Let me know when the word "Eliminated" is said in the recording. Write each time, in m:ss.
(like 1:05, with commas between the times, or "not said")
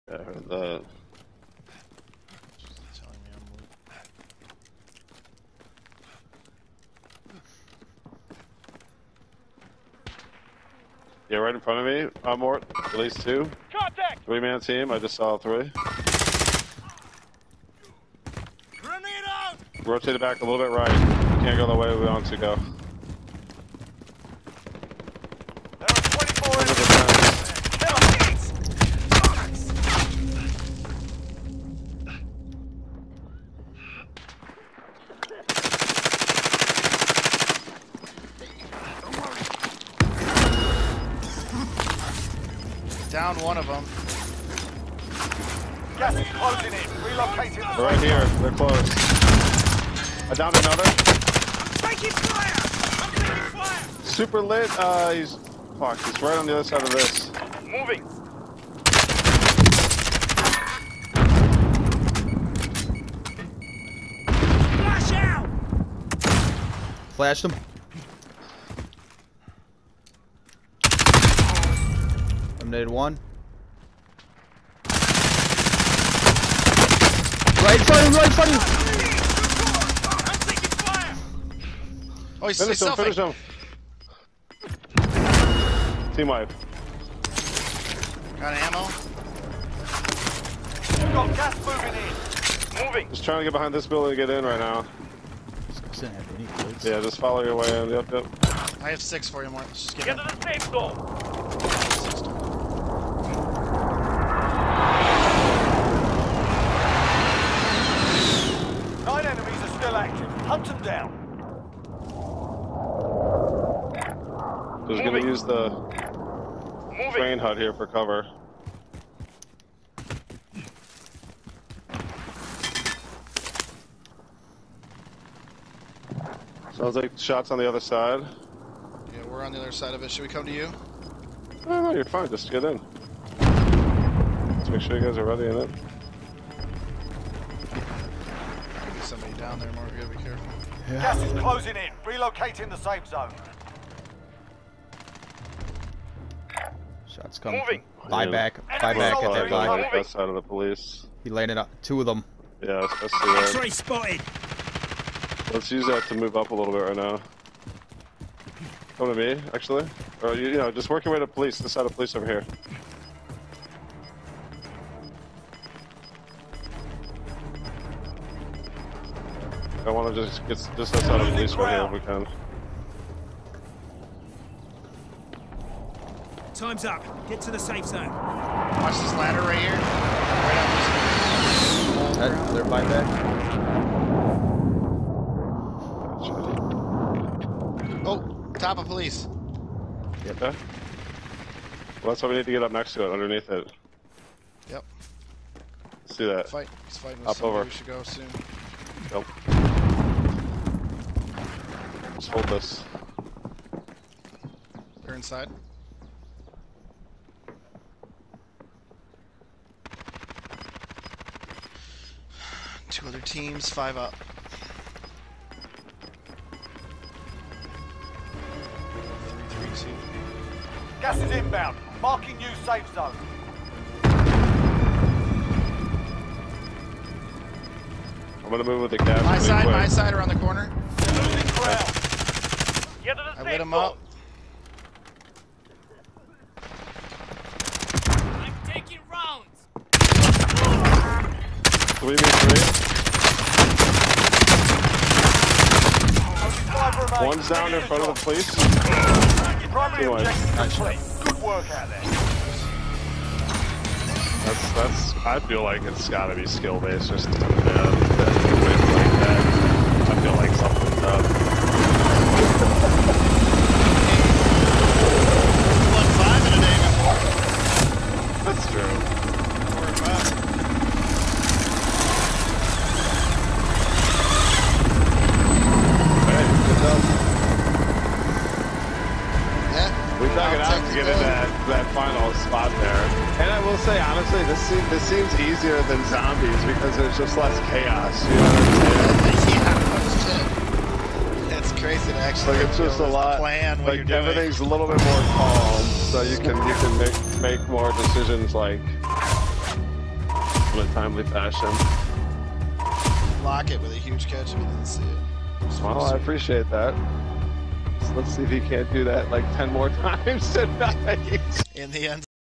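1:12.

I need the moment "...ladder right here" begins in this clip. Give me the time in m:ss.
2:59.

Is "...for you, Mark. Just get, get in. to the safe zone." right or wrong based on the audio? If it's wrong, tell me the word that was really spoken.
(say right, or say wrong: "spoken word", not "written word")
right.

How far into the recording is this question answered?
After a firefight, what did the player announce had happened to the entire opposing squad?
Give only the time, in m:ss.
1:26.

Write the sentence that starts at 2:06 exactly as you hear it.
Sounds like shots on the other side.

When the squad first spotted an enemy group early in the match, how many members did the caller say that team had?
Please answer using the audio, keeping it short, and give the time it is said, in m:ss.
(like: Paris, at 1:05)
3, at 0:14.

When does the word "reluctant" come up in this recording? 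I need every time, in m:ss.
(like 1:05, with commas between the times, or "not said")
not said.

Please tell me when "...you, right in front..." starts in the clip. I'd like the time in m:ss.
1:18.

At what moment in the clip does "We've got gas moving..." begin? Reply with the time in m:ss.
1:30.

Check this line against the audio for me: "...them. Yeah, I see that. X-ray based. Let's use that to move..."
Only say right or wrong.
wrong.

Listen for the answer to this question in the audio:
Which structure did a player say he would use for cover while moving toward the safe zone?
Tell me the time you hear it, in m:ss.
1:57.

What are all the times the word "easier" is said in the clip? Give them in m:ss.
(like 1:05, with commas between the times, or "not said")
4:45.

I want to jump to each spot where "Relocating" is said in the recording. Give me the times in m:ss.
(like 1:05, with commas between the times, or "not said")
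0:47, 2:22.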